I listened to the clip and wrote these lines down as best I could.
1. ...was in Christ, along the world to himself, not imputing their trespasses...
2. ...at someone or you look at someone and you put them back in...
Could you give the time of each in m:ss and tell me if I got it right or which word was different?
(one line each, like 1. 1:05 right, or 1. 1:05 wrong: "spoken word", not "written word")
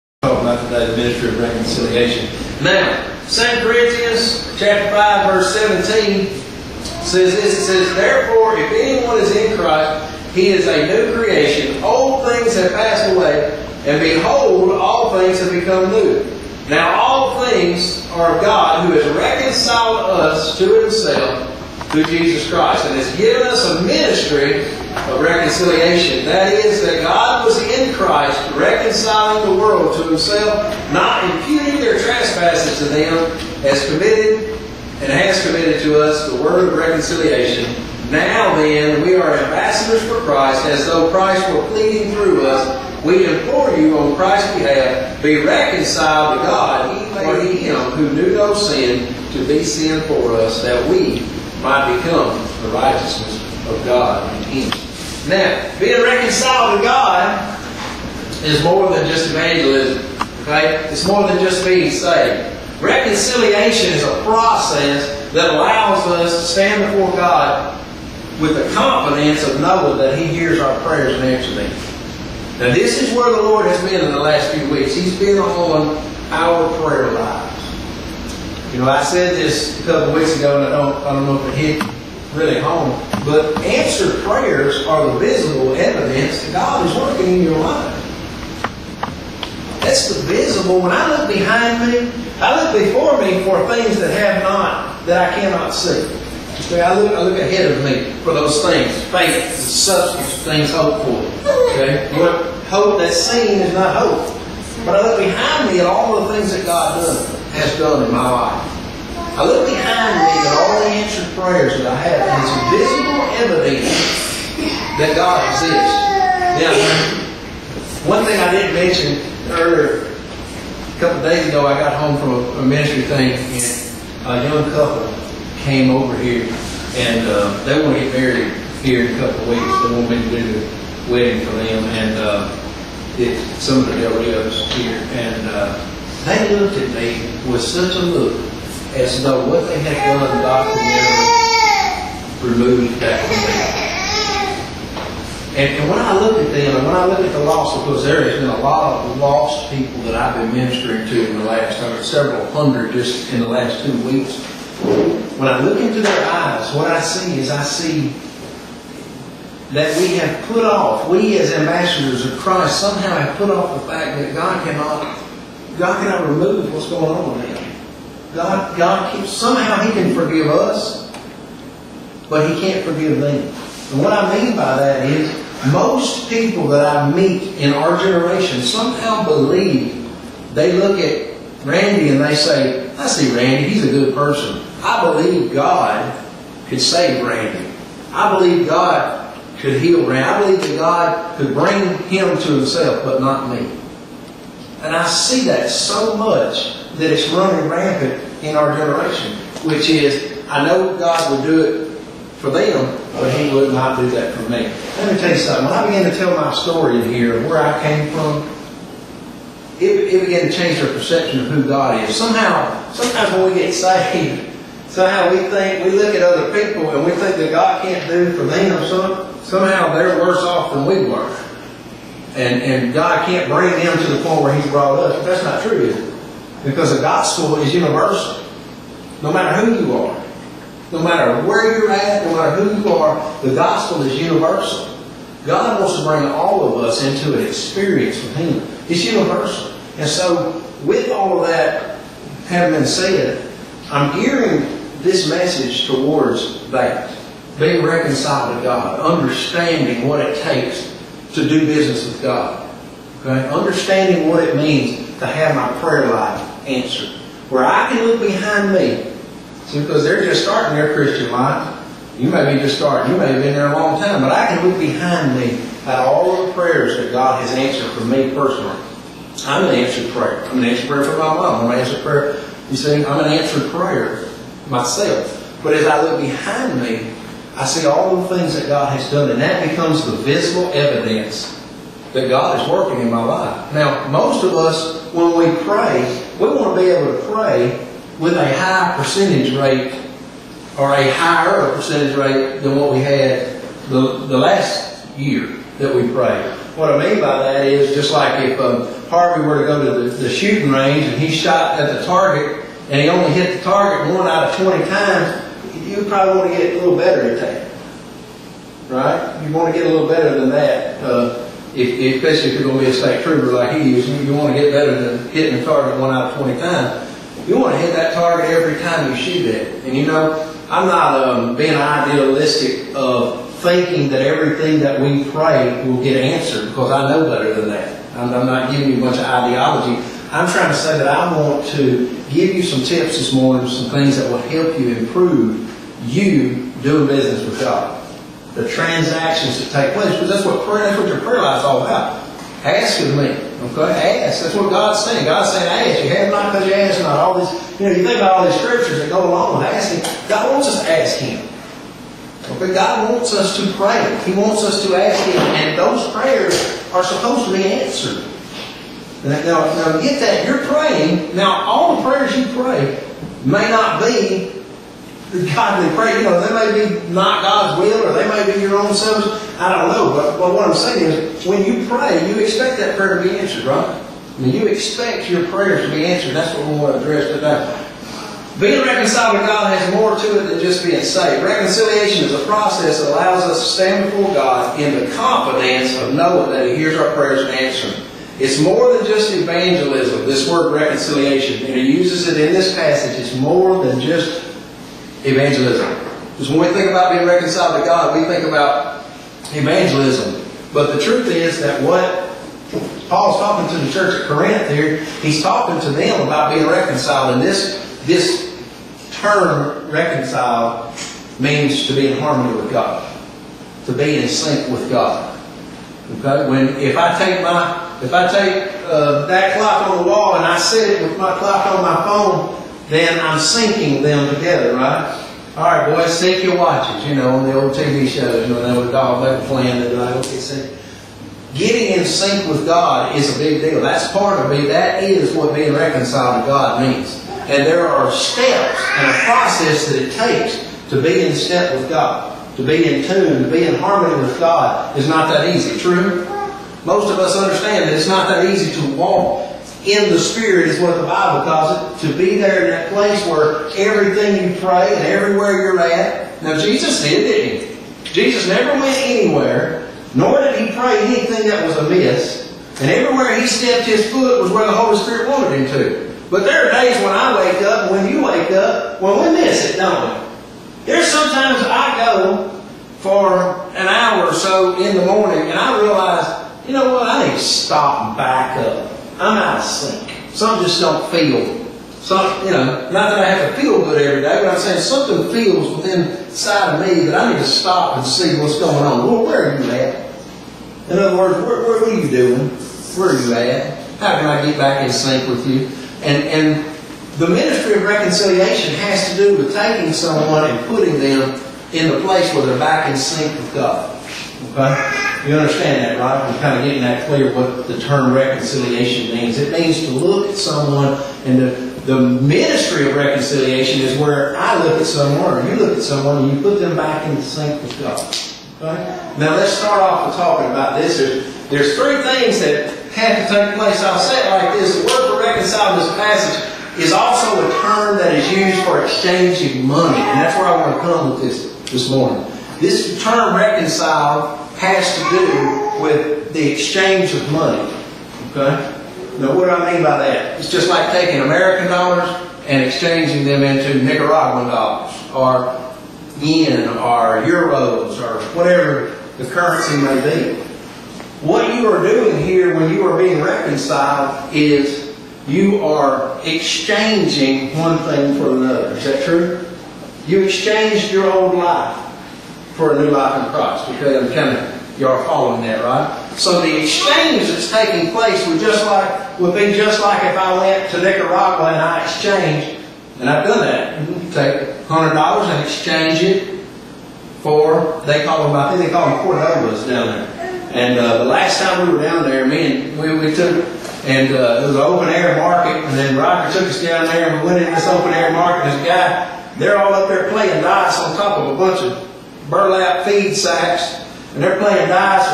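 1. 0:27 wrong: "reconciling", not "along"
2. 8:34 right.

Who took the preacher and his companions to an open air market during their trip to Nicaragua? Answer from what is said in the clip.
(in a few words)
Roger.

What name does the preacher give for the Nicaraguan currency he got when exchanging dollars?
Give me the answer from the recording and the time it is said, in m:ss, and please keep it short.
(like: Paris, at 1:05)
cordobas, at 9:39.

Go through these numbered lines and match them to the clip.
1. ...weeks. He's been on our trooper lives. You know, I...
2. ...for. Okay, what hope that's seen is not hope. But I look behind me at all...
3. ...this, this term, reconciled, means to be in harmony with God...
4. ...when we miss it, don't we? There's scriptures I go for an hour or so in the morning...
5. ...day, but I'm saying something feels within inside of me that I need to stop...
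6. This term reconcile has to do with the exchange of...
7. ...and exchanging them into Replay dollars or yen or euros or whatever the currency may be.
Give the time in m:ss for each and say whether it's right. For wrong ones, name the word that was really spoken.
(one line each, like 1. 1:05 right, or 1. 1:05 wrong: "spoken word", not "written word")
1. 1:14 wrong: "prayer", not "trooper"
2. 1:41 right
3. 6:47 right
4. 7:49 wrong: "sometimes", not "scriptures"
5. 8:04 right
6. 8:52 right
7. 9:02 wrong: "Nicaraguan", not "Replay".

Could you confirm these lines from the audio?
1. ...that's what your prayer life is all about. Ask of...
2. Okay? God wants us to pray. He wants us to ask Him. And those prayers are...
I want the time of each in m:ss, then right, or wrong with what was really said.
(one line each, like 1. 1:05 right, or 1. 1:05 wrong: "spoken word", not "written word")
1. 5:40 right
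2. 5:52 right.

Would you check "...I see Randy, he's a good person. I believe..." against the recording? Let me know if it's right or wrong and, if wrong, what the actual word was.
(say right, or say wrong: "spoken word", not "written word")
right.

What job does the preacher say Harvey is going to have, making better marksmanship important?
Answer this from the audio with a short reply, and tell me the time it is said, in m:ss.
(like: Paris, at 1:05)
state trooper, at 5:12.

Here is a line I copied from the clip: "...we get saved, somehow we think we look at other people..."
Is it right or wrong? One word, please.
right.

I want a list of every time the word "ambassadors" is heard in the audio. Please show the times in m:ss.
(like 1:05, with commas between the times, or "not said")
0:39, 2:41.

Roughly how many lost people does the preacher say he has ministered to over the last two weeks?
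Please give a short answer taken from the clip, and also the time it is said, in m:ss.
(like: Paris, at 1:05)
several hundred, at 2:32.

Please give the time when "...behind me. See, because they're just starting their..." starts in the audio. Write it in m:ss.
4:18.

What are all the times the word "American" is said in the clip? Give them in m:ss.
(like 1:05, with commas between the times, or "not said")
9:01.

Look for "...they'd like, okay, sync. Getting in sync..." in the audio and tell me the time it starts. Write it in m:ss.
7:09.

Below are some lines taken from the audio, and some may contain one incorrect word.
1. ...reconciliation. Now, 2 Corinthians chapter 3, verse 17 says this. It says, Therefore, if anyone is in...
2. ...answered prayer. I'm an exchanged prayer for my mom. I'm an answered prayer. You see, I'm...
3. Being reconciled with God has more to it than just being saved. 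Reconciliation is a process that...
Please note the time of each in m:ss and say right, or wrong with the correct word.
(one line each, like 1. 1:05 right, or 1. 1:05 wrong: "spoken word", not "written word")
1. 0:01 wrong: "5", not "3"
2. 4:29 wrong: "answered", not "exchanged"
3. 6:18 right.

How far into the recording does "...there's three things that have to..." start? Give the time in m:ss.
8:41.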